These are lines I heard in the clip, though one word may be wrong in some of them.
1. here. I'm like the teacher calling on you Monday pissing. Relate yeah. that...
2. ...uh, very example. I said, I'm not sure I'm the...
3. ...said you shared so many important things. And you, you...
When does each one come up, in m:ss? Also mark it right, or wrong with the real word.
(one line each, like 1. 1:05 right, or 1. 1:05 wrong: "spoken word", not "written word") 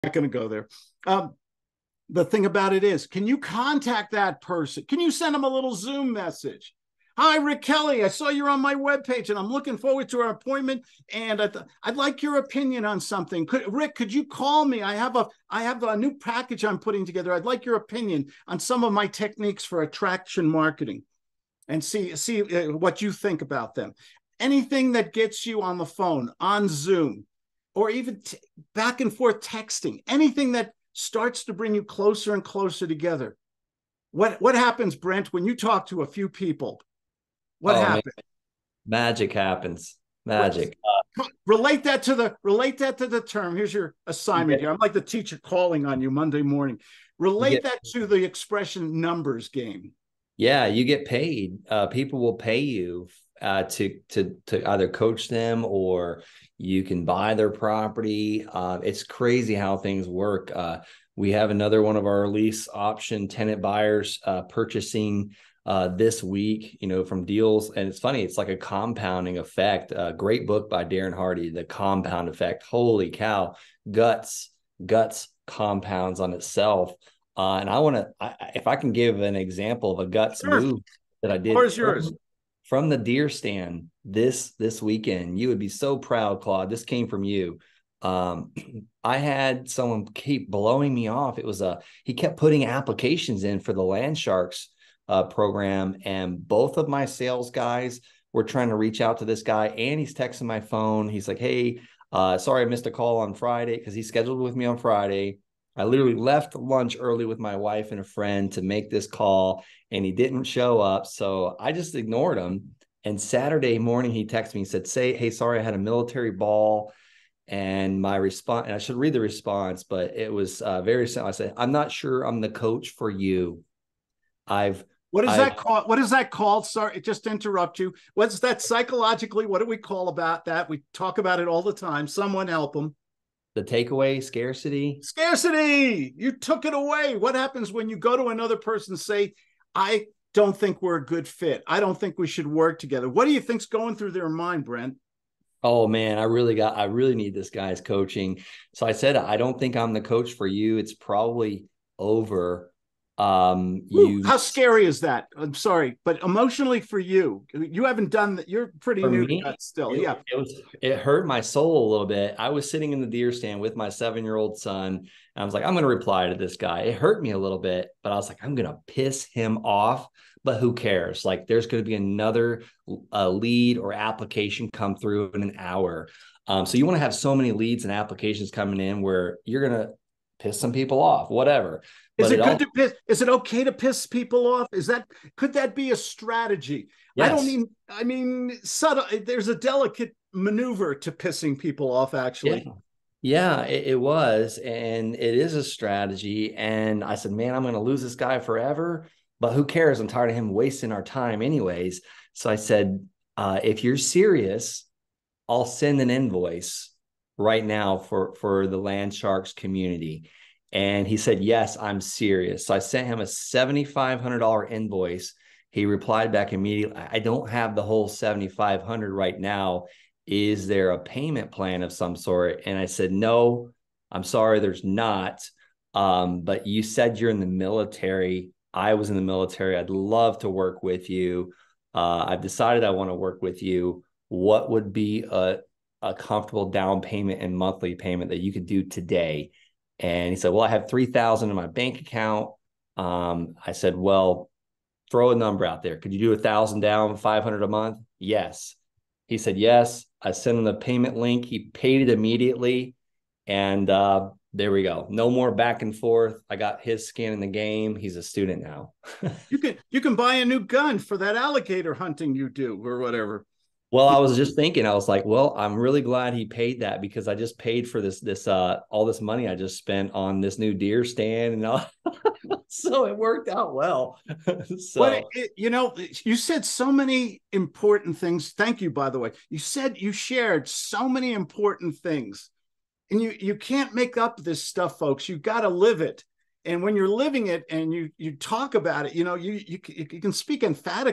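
1. 0:44 wrong: "morning", not "pissing"
2. 2:00 wrong: "simple", not "example"
3. 4:39 right.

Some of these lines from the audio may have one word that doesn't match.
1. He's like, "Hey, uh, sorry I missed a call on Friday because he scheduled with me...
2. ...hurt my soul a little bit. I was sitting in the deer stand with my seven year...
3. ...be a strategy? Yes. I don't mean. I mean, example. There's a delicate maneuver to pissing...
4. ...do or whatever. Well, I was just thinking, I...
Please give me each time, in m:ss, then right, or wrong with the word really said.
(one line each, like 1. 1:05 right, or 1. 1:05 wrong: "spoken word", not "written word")
1. 1:41 right
2. 2:40 right
3. 3:05 wrong: "subtle", not "example"
4. 4:22 right.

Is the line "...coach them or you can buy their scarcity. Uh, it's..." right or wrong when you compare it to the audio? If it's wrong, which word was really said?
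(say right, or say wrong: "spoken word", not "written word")
wrong: "property", not "scarcity".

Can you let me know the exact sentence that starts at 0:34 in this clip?
What what happens, Brent, when you talk to a few people?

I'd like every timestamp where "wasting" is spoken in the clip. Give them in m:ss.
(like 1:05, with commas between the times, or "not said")
3:20.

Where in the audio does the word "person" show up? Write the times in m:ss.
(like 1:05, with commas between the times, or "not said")
0:04, 2:18.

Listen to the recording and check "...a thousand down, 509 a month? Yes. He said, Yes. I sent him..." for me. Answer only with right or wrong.
wrong.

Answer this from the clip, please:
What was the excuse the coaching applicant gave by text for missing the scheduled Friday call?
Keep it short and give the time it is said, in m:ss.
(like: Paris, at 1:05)
A military ball, at 1:55.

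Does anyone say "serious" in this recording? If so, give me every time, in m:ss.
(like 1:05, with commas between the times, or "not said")
3:23, 3:31.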